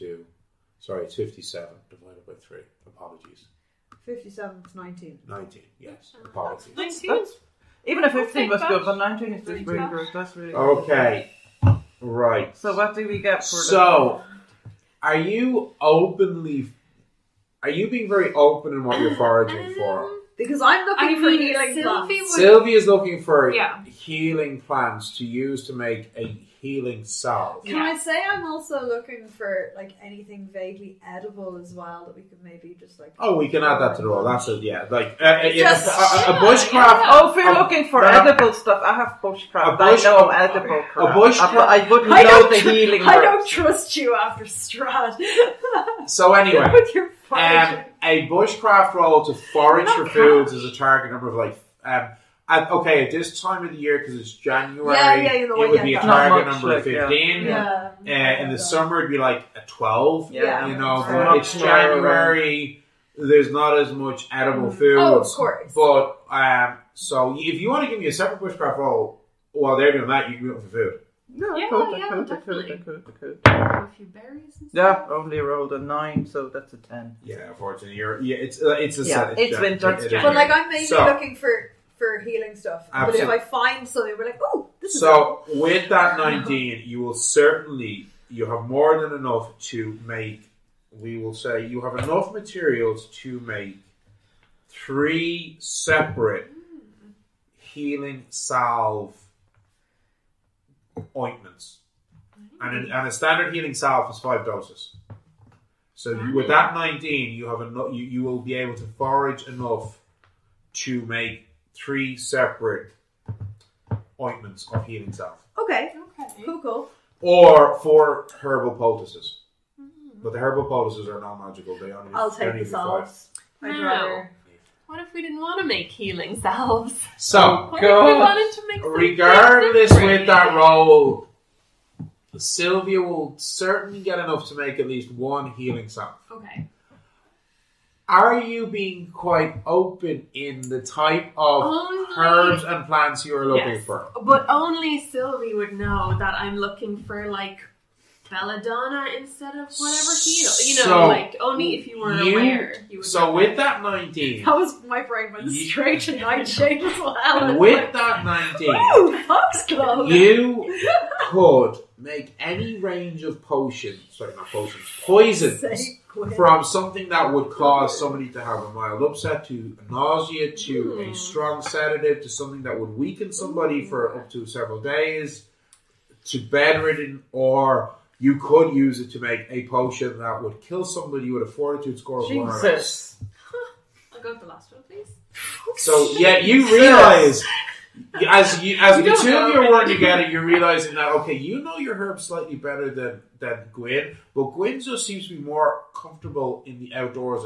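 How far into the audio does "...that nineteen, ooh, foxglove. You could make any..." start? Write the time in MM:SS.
02:37.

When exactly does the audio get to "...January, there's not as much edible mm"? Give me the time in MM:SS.
01:01.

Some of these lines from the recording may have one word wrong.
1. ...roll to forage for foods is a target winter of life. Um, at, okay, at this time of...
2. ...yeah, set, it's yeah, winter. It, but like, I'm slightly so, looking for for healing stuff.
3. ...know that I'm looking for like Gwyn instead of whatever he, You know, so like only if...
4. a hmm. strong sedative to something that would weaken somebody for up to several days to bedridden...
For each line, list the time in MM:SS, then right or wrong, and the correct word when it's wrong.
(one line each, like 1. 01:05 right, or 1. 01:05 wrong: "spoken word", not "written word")
1. 00:48 wrong: "number", not "winter"
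2. 01:19 wrong: "mainly", not "slightly"
3. 02:25 wrong: "Belladonna", not "Gwyn"
4. 02:51 right.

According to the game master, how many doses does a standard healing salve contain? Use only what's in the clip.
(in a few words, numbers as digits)
5.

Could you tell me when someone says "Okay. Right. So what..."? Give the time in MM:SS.
00:10.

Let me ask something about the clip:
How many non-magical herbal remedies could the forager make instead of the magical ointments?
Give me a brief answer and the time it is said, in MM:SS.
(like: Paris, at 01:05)
4, at 01:57.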